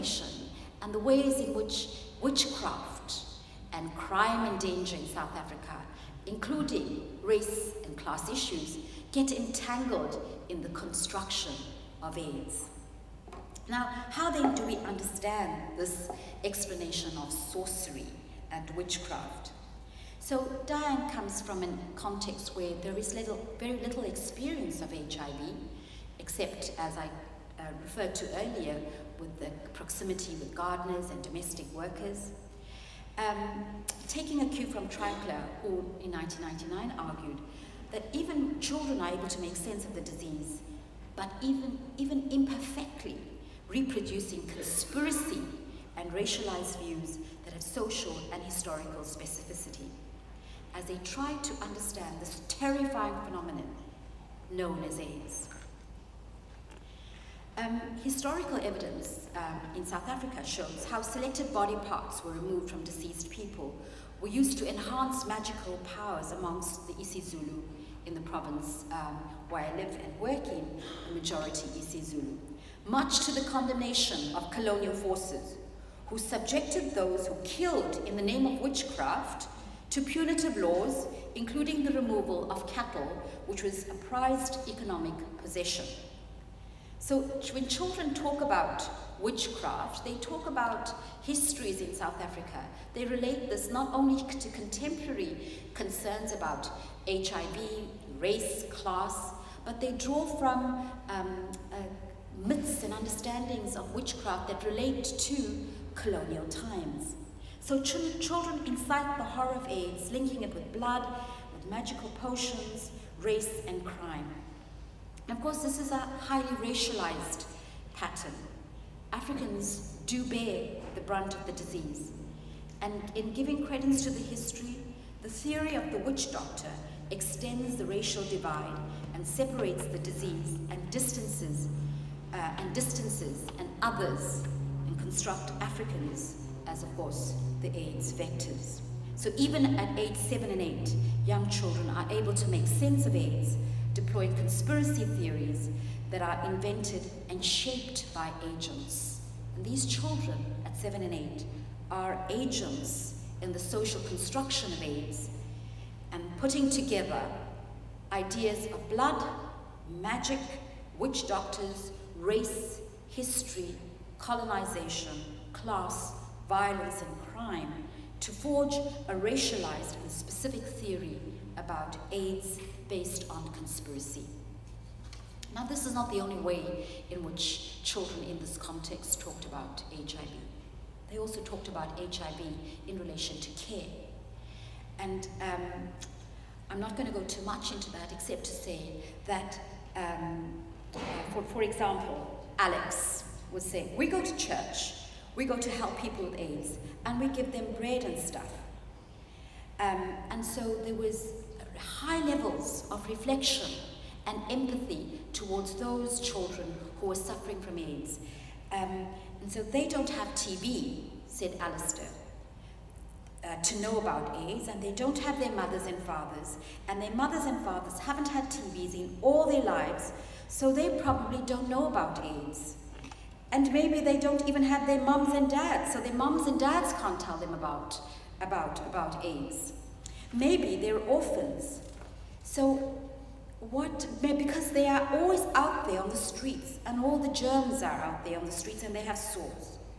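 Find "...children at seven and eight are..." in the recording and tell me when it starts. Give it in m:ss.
2:29.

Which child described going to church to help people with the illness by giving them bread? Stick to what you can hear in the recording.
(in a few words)
Alex.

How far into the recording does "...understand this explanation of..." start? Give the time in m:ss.
0:14.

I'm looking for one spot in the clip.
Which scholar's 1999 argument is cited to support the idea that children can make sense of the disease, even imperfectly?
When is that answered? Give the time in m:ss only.
0:34.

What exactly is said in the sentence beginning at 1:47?
So ch children incite the horror of AIDS, linking it with blood, with magical potions, race, and crime.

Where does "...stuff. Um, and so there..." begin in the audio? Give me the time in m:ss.
3:18.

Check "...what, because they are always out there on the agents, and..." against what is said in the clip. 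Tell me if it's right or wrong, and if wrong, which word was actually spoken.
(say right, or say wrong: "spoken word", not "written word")
wrong: "streets", not "agents".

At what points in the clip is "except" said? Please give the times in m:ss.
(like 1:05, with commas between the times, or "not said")
0:26, 3:08.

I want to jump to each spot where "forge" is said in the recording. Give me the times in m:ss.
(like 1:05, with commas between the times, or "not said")
2:48.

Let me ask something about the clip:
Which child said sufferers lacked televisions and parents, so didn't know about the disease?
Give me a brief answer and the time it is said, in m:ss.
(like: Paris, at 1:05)
Alistair, at 3:31.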